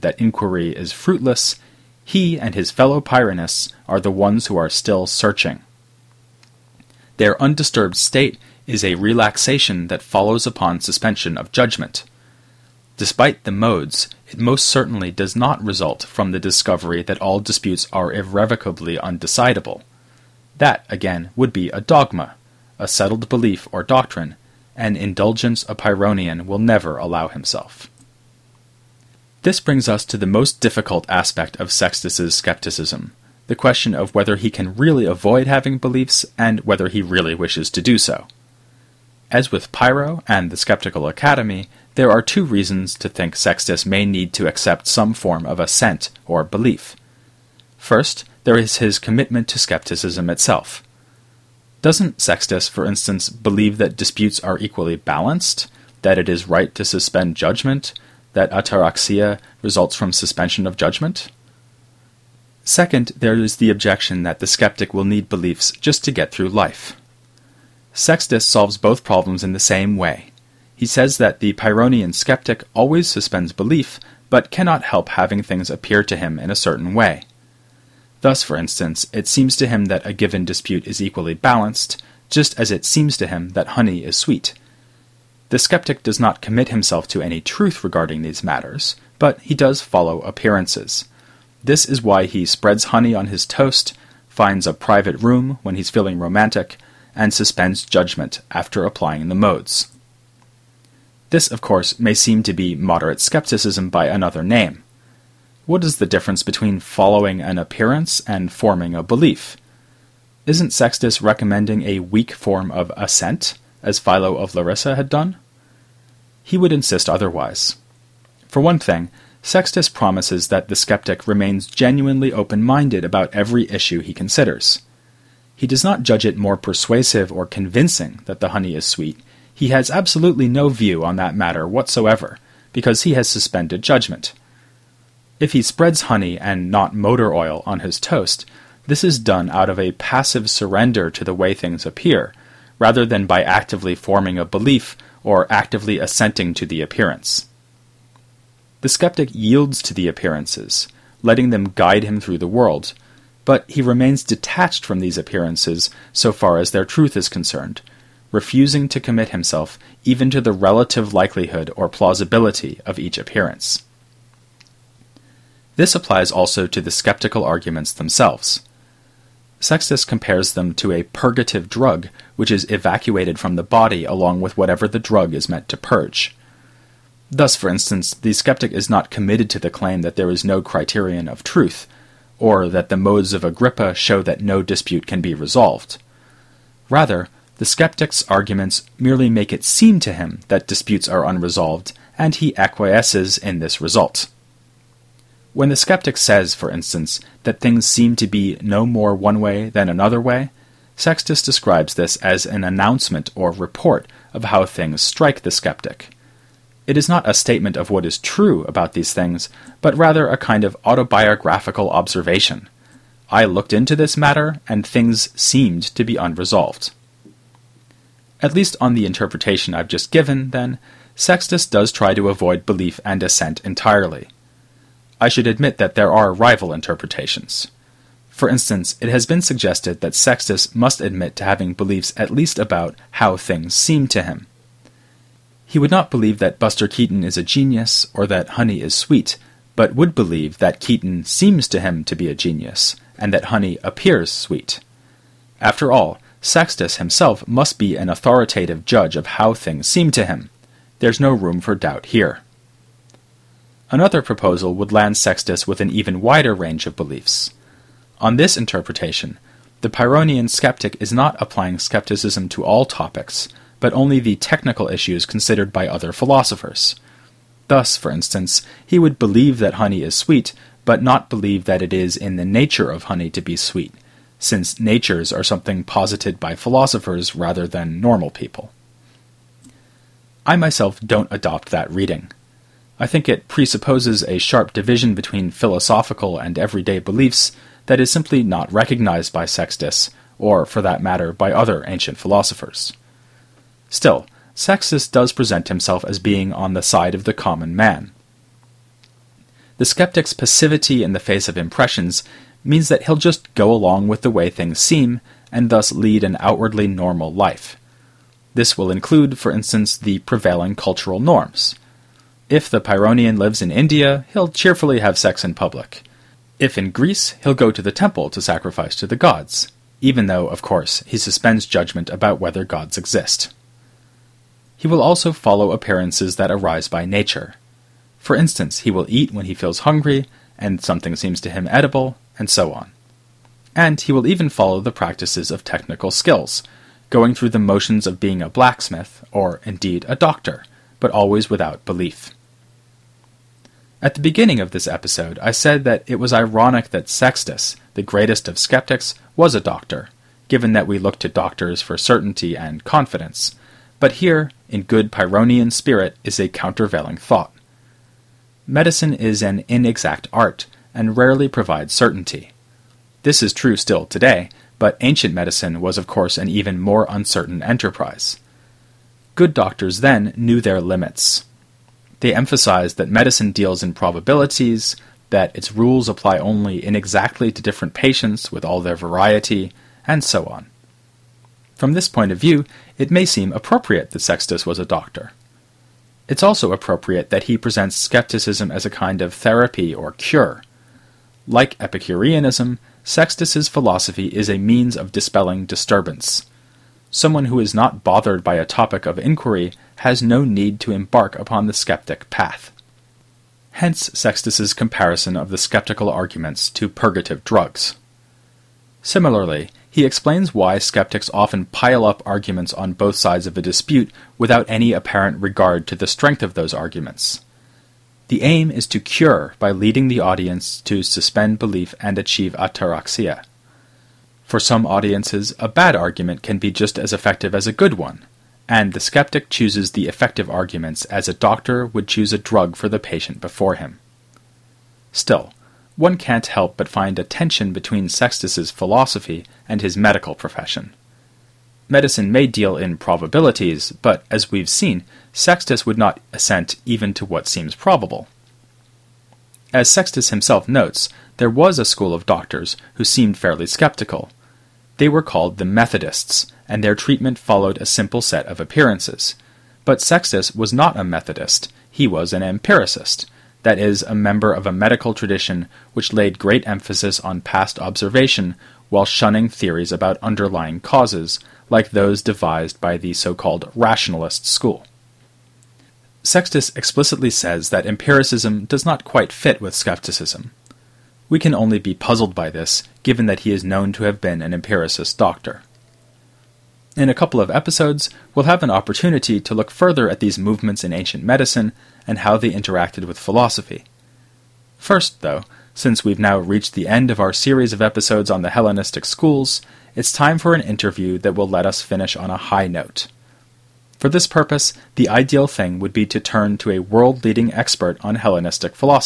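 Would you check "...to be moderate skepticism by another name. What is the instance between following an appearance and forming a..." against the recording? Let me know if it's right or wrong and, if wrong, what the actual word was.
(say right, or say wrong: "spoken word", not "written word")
wrong: "difference", not "instance".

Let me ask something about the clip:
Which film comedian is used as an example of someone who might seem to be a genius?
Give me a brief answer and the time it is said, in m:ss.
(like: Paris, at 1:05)
Buster Keaton, at 3:56.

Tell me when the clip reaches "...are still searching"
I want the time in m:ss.
0:04.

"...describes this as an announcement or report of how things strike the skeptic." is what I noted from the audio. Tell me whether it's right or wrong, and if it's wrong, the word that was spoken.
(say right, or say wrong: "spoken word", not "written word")
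right.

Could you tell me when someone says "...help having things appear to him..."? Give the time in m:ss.
1:14.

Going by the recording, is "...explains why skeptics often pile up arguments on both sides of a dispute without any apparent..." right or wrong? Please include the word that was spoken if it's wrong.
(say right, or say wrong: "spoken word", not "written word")
right.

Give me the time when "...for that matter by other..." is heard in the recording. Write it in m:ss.
4:50.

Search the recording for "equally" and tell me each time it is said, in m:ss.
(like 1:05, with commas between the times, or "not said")
0:54, 1:20.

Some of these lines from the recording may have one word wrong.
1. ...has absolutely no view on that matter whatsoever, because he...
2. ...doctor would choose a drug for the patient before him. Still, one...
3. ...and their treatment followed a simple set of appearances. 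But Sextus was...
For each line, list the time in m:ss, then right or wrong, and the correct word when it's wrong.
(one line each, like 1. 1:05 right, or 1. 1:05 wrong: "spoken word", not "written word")
1. 2:09 right
2. 7:11 right
3. 7:36 right.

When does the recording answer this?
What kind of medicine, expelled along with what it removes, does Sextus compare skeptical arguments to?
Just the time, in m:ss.
2:51.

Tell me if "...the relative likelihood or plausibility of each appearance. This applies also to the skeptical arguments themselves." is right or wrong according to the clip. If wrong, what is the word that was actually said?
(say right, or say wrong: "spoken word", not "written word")
right.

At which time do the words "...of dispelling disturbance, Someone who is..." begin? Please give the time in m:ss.
6:34.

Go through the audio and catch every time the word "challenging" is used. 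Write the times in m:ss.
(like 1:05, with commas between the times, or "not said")
not said.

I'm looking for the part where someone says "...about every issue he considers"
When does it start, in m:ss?
2:03.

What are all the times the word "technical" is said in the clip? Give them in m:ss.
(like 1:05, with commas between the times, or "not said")
4:24, 5:35.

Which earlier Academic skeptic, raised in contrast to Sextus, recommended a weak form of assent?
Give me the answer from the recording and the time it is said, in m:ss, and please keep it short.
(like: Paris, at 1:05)
Philo of Larissa, at 1:53.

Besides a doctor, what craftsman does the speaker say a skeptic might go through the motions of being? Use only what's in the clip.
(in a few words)
A blacksmith.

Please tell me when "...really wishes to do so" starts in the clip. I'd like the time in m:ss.
0:37.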